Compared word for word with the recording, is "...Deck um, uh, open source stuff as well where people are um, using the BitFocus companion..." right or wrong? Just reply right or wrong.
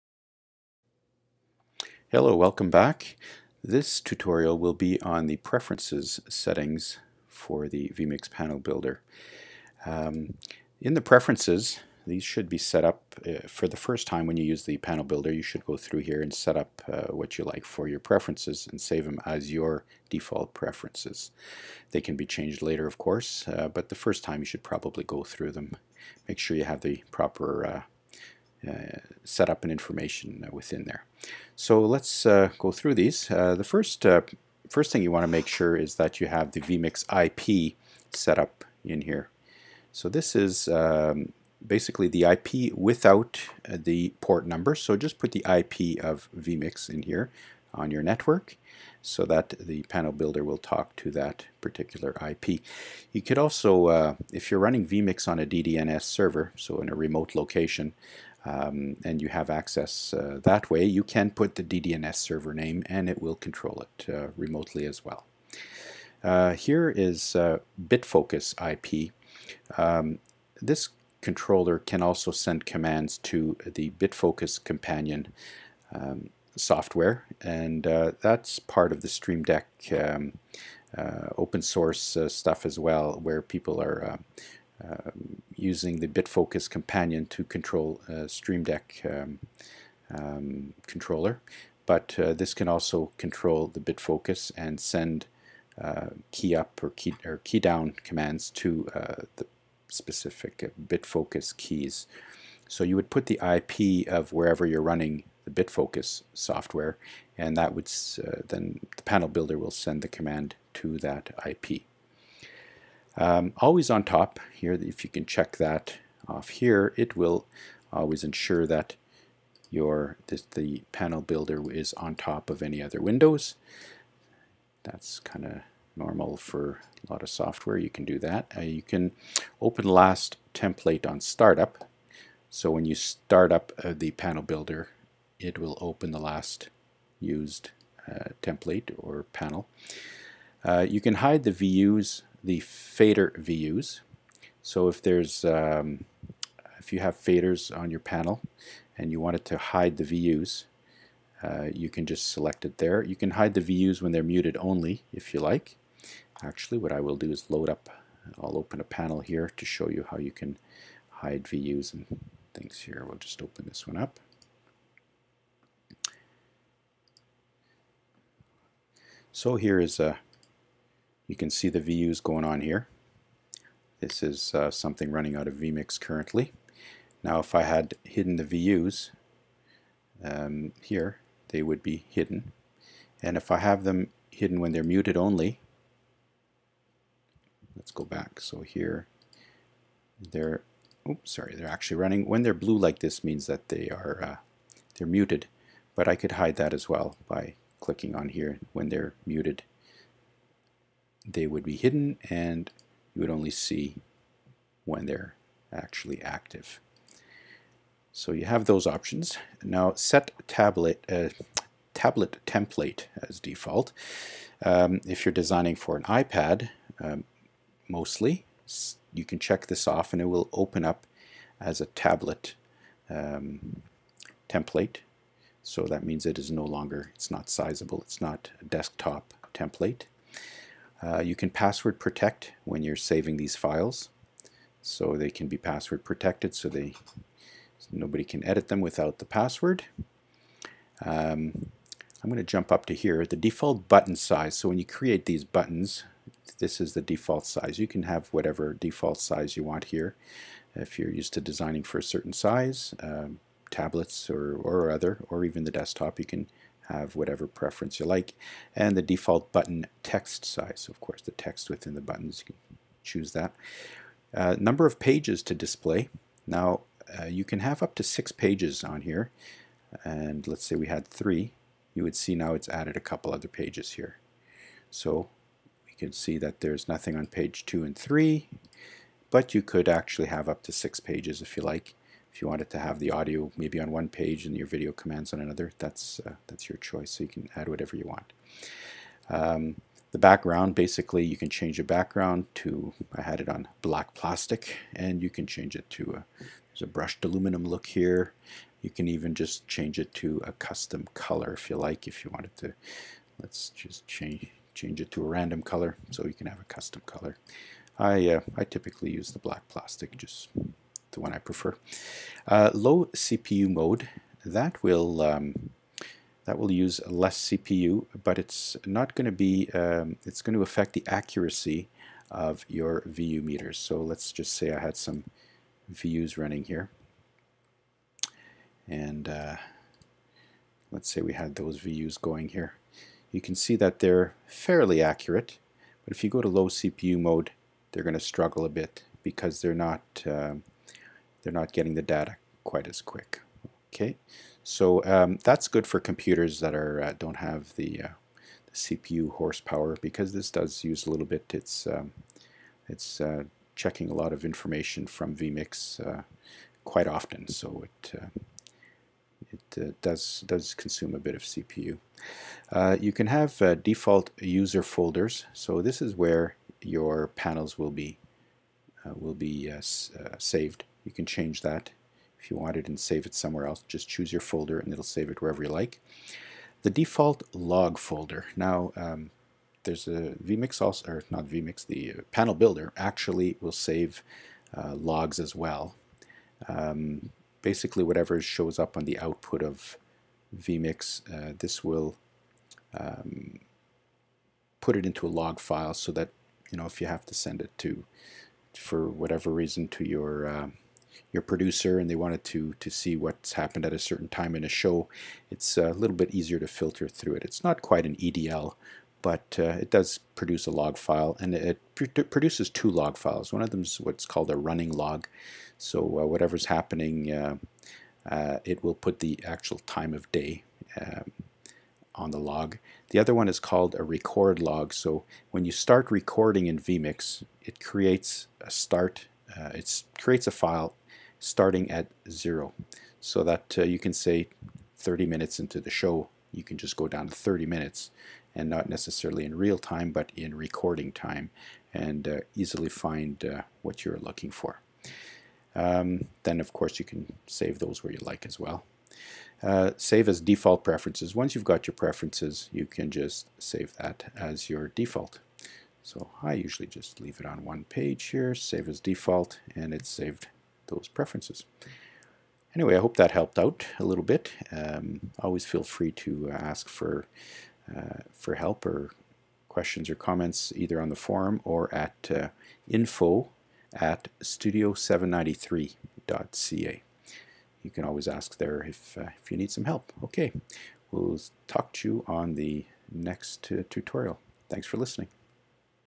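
right.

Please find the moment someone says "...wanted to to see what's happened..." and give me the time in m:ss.
6:42.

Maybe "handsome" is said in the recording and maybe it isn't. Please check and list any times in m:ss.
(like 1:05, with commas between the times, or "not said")
not said.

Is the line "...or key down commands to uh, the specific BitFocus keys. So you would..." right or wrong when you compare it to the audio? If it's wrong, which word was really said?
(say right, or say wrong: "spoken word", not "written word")
right.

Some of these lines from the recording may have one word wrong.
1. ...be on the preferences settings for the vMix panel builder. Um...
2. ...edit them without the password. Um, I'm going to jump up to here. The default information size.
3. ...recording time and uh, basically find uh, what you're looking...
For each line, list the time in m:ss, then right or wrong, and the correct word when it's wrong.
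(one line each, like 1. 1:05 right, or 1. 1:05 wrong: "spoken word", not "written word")
1. 0:04 right
2. 3:58 wrong: "button", not "information"
3. 7:20 wrong: "easily", not "basically".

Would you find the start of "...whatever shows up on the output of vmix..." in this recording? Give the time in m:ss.
6:28.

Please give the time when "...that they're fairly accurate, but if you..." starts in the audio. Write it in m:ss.
5:33.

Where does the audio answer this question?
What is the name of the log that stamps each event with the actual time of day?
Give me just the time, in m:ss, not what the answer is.
6:54.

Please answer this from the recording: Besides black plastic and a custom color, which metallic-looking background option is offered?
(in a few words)
Brushed aluminum.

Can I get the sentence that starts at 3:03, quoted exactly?
And if I have them hidden when they're muted only, let's go back.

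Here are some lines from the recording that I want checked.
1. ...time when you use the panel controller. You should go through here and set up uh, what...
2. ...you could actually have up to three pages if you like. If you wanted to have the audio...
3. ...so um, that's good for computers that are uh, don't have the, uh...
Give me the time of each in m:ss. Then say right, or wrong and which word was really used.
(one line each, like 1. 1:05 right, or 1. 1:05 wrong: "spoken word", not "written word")
1. 0:14 wrong: "builder", not "controller"
2. 4:39 wrong: "six", not "three"
3. 5:44 right.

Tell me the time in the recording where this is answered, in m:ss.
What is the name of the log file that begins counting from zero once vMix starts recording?
7:04.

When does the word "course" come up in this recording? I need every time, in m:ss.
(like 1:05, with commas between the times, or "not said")
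0:22, 4:20, 7:26.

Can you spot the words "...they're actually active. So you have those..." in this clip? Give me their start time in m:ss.
3:25.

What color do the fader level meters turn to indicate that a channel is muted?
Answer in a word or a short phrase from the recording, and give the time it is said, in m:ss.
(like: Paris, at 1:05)
Blue, at 3:12.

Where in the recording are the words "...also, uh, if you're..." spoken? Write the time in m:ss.
0:53.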